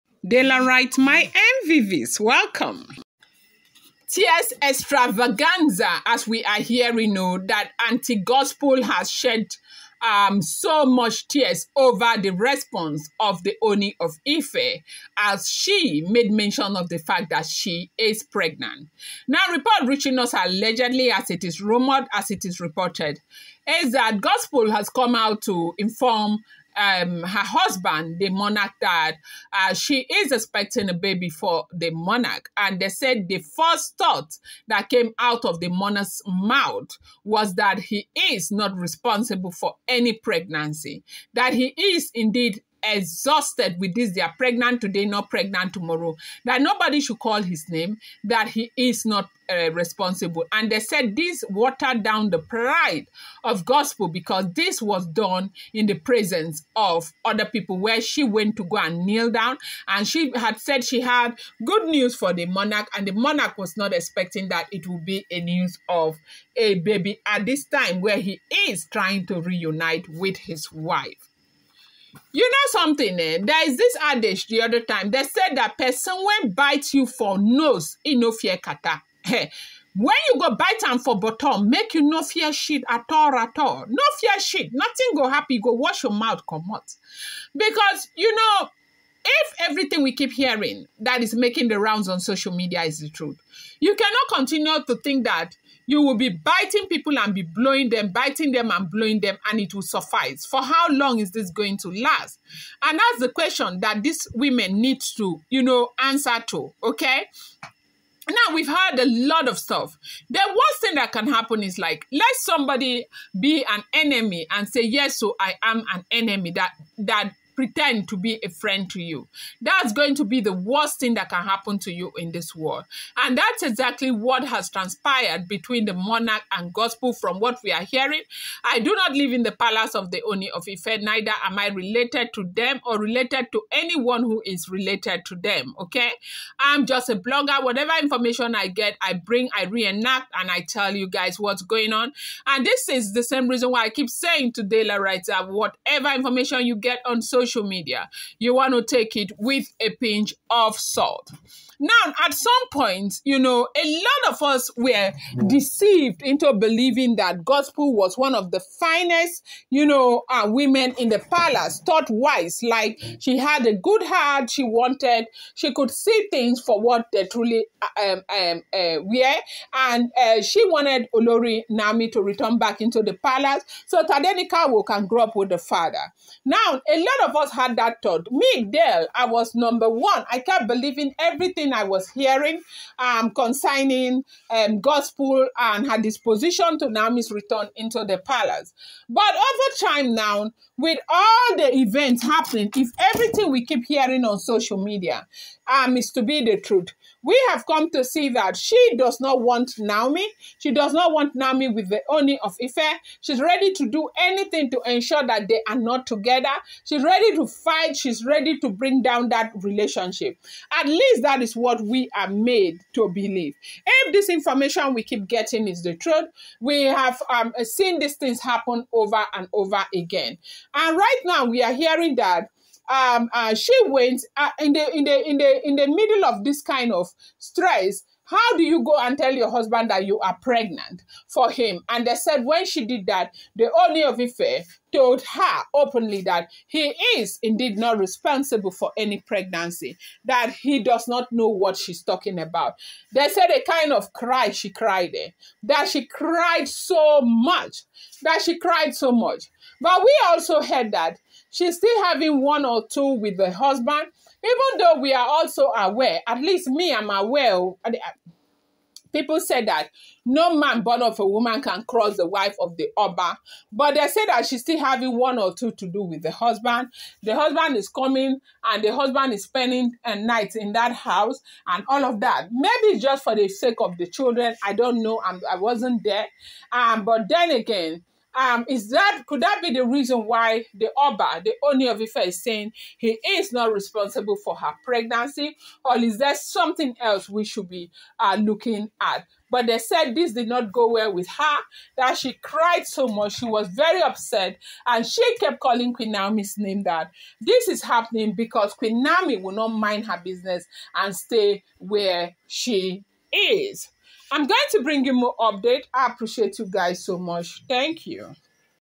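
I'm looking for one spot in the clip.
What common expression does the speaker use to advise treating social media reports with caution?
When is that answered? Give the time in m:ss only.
2:29.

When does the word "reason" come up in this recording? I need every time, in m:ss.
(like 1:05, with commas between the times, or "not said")
2:23, 4:39.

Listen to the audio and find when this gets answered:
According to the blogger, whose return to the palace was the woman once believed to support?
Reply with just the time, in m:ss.
2:51.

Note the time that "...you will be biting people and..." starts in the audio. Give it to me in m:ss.
1:35.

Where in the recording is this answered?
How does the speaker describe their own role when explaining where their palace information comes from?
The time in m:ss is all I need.
2:17.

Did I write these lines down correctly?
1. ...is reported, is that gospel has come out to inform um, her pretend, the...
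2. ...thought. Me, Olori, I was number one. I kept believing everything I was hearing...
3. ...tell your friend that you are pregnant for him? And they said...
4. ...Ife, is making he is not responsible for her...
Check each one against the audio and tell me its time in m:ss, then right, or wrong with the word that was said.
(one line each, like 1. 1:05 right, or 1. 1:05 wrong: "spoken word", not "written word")
1. 0:22 wrong: "husband", not "pretend"
2. 2:58 wrong: "Dell", not "Olori"
3. 3:49 wrong: "husband", not "friend"
4. 4:42 wrong: "saying", not "making".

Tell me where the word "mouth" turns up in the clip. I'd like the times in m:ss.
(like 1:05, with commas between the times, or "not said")
0:36, 1:26.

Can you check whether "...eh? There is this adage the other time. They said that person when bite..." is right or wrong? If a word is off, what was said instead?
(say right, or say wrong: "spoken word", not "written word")
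right.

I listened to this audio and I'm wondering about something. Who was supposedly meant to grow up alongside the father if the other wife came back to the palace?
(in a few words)
Tadenikawo.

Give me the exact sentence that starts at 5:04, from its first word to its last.
I'm going to bring you more update.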